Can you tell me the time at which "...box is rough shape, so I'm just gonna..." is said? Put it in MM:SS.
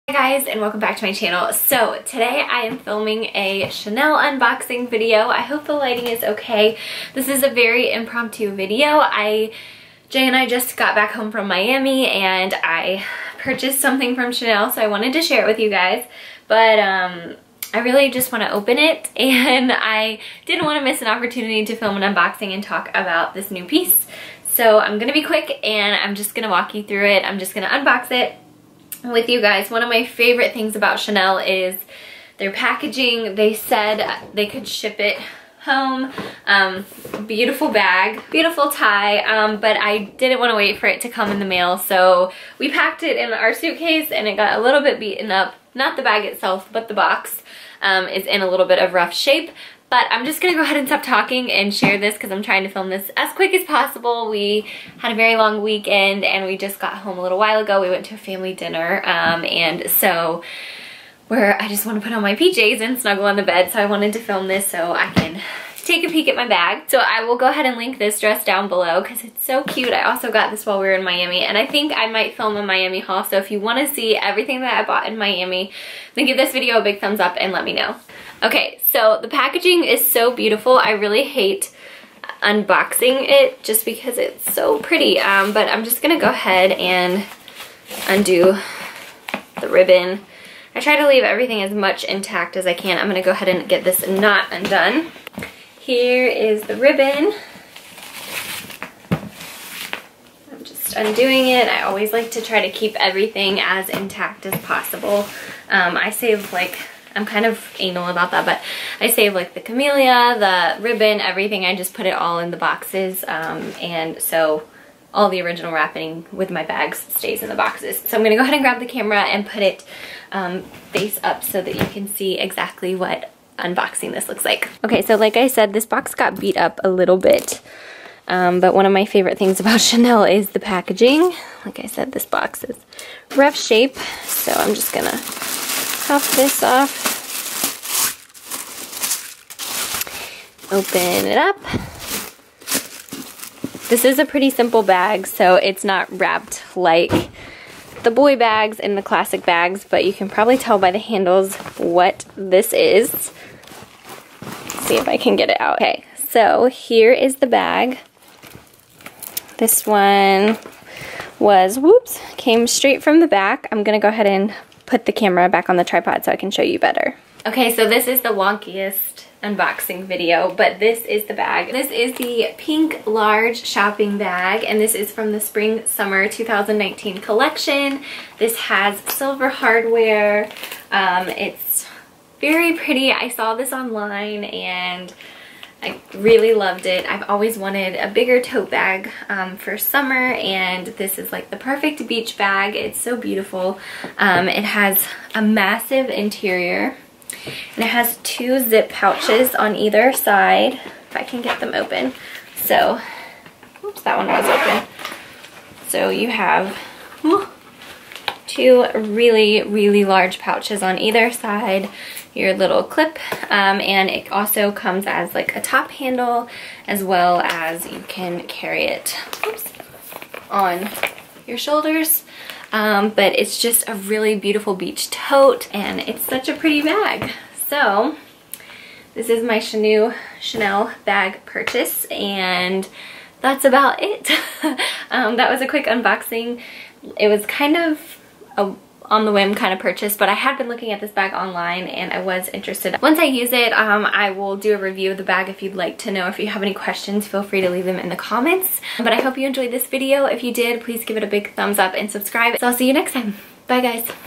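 02:12.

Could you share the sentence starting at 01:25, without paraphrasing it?
Um, but I'm just going to go ahead and undo the ribbon.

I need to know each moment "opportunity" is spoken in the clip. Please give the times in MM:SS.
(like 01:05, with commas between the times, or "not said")
00:21.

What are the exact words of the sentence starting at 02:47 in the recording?
Okay, so this is the wonkiest unboxing video, but this is the bag.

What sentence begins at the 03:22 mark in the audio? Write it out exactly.
So, oops, that one was open.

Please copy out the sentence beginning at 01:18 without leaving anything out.
Okay, so the packaging is so beautiful.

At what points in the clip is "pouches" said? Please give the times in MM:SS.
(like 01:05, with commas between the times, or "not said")
03:18, 03:30.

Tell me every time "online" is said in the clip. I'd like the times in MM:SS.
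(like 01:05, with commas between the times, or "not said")
03:03, 04:01.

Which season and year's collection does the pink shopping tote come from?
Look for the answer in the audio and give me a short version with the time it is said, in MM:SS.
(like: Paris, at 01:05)
spring summer 2019, at 02:55.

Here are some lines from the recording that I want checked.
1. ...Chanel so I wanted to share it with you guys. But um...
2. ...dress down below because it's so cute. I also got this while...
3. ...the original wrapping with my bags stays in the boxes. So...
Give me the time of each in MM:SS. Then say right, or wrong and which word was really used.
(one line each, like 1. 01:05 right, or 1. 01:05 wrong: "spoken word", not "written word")
1. 00:14 right
2. 01:08 right
3. 01:55 right.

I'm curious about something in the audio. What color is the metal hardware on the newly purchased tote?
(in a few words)
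silver.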